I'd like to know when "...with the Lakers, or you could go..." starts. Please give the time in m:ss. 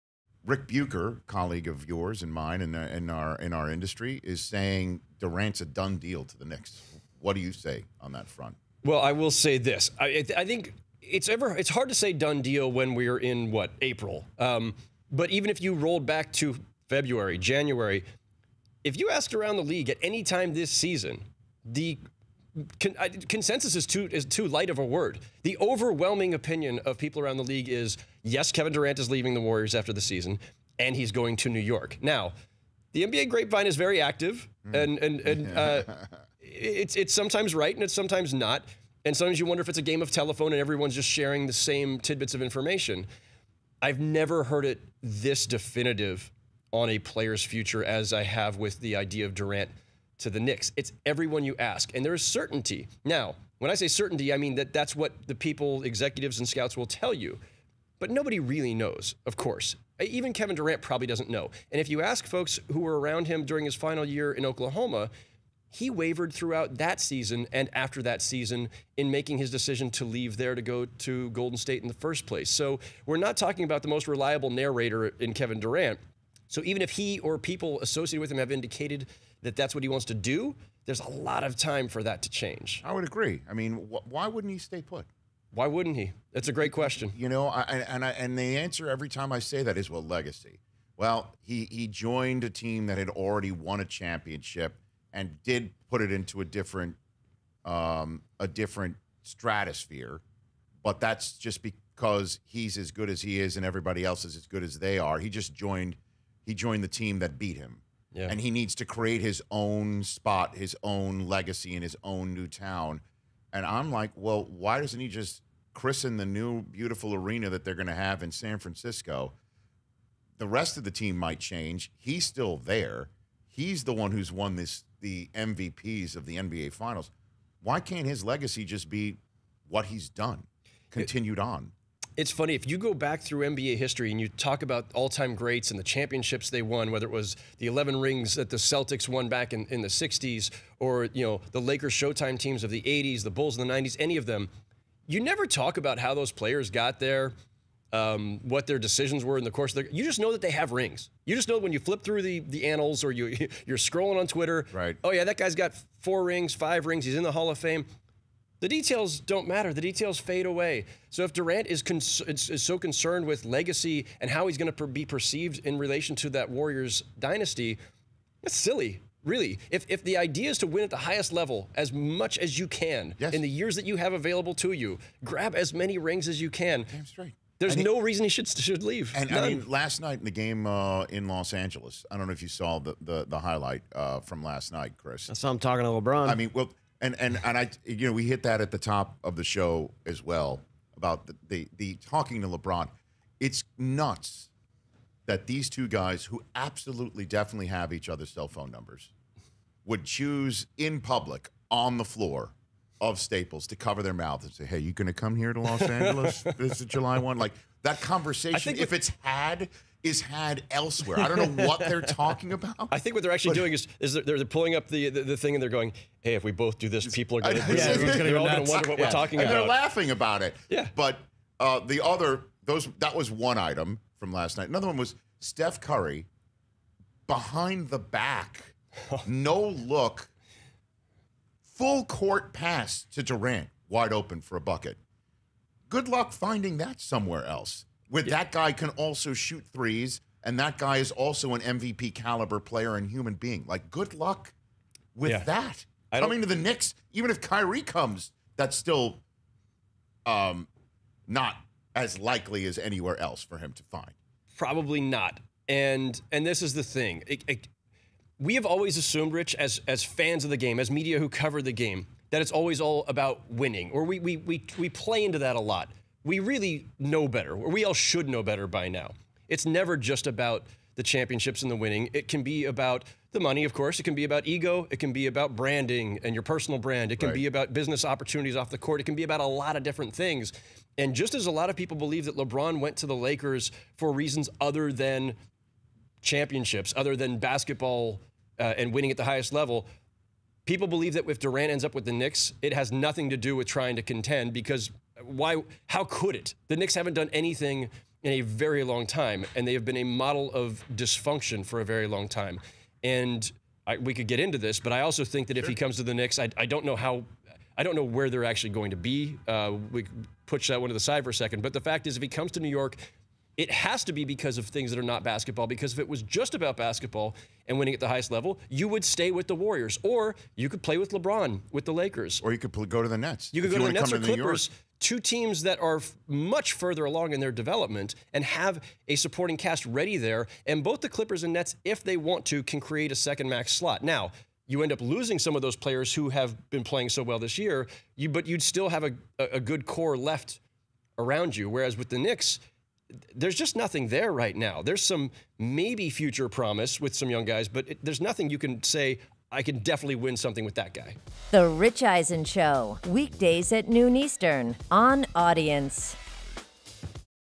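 5:21.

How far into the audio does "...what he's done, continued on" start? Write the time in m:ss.
2:09.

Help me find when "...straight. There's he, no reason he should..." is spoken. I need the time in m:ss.
2:57.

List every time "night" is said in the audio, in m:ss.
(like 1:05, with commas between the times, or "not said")
3:00, 3:04, 3:44.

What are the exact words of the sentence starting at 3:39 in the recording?
we're talking and about." They're laughing about it.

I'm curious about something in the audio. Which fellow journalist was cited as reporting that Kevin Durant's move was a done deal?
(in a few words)
Ric Bucher.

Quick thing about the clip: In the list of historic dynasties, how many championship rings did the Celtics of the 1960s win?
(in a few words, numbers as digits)
11.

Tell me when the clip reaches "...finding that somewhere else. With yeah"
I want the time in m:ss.
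3:56.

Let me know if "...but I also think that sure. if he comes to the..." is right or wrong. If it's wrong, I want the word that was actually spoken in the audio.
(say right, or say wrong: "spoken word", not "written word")
right.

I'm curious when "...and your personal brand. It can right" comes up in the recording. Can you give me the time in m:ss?
4:36.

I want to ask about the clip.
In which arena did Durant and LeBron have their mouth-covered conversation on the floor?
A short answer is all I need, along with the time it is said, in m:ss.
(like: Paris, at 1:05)
Staples, at 3:23.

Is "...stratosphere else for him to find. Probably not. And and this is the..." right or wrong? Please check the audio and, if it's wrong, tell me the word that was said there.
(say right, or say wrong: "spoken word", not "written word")
wrong: "anywhere", not "stratosphere".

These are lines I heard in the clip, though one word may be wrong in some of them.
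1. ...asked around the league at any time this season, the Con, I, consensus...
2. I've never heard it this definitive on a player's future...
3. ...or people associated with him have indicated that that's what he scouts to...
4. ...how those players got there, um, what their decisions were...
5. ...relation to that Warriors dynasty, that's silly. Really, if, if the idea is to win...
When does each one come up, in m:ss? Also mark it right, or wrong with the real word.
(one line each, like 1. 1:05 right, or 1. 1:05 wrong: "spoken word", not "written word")
1. 0:19 right
2. 0:43 right
3. 1:17 wrong: "wants", not "scouts"
4. 2:25 right
5. 2:45 right.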